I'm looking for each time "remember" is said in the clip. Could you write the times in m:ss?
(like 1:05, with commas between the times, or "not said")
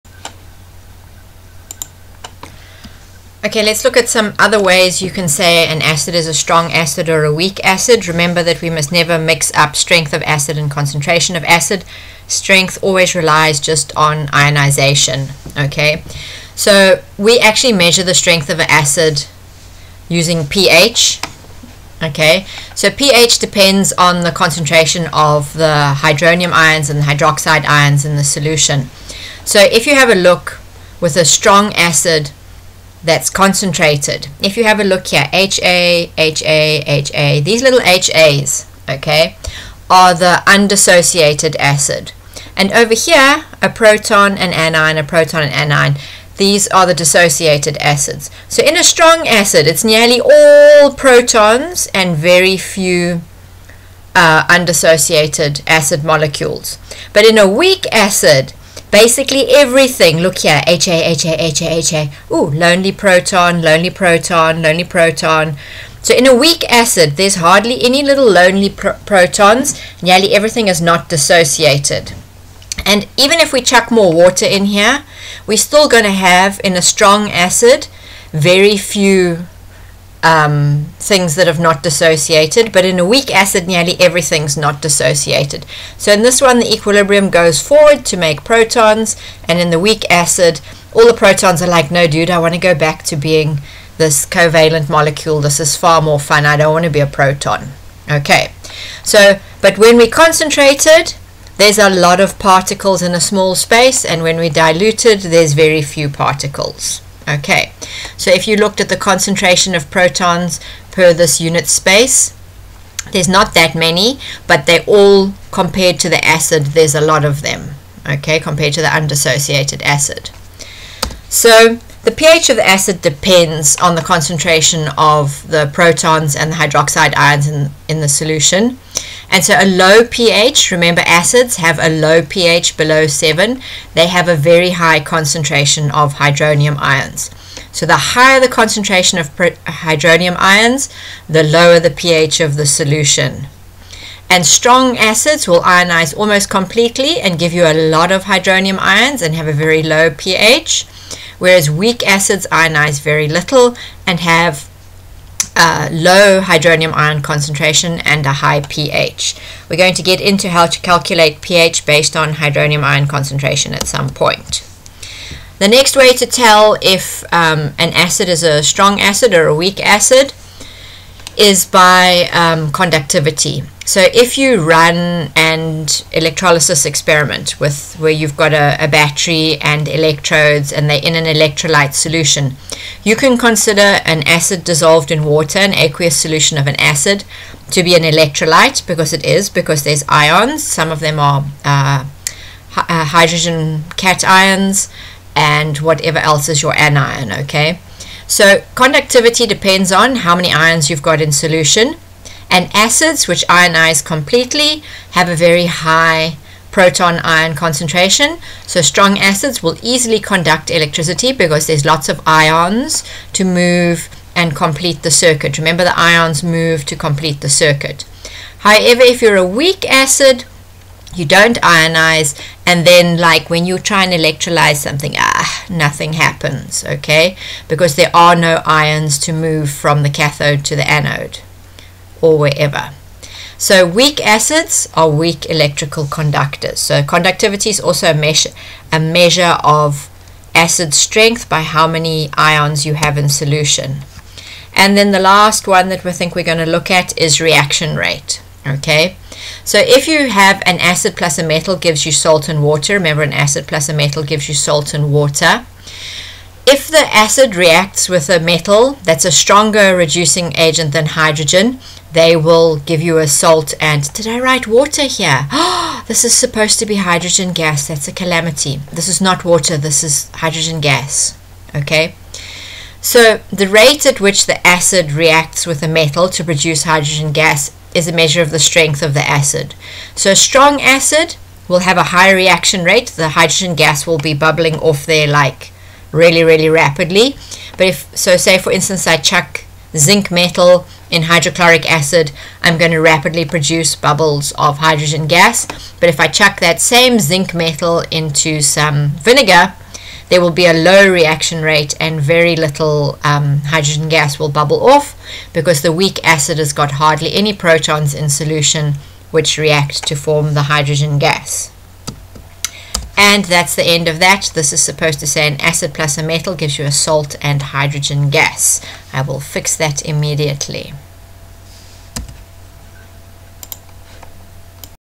0:08, 2:10, 3:35, 4:12.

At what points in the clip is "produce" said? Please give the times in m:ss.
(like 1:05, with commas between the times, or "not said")
4:36, 4:53.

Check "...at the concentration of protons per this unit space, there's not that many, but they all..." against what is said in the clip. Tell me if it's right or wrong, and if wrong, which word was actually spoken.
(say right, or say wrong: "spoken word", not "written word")
right.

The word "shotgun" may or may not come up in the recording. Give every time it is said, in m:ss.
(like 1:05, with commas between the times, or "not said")
not said.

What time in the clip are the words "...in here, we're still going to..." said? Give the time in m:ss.
1:14.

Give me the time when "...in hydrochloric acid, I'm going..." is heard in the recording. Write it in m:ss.
4:51.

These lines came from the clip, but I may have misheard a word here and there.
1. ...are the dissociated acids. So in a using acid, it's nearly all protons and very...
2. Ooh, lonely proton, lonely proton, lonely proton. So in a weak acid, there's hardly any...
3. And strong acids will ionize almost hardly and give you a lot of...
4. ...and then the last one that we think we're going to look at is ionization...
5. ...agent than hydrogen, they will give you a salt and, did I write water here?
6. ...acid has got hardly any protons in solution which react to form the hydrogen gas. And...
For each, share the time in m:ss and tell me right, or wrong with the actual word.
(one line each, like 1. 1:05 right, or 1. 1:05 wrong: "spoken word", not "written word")
1. 0:46 wrong: "strong", not "using"
2. 1:02 right
3. 2:24 wrong: "completely", not "hardly"
4. 4:04 wrong: "reaction", not "ionization"
5. 4:20 right
6. 5:06 right.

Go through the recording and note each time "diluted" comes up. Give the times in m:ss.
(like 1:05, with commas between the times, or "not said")
1:44.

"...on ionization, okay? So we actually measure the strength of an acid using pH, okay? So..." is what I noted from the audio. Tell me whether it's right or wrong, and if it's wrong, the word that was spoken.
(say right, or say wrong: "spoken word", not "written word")
right.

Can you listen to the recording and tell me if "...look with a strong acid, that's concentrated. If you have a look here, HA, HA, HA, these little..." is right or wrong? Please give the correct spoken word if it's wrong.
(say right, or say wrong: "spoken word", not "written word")
right.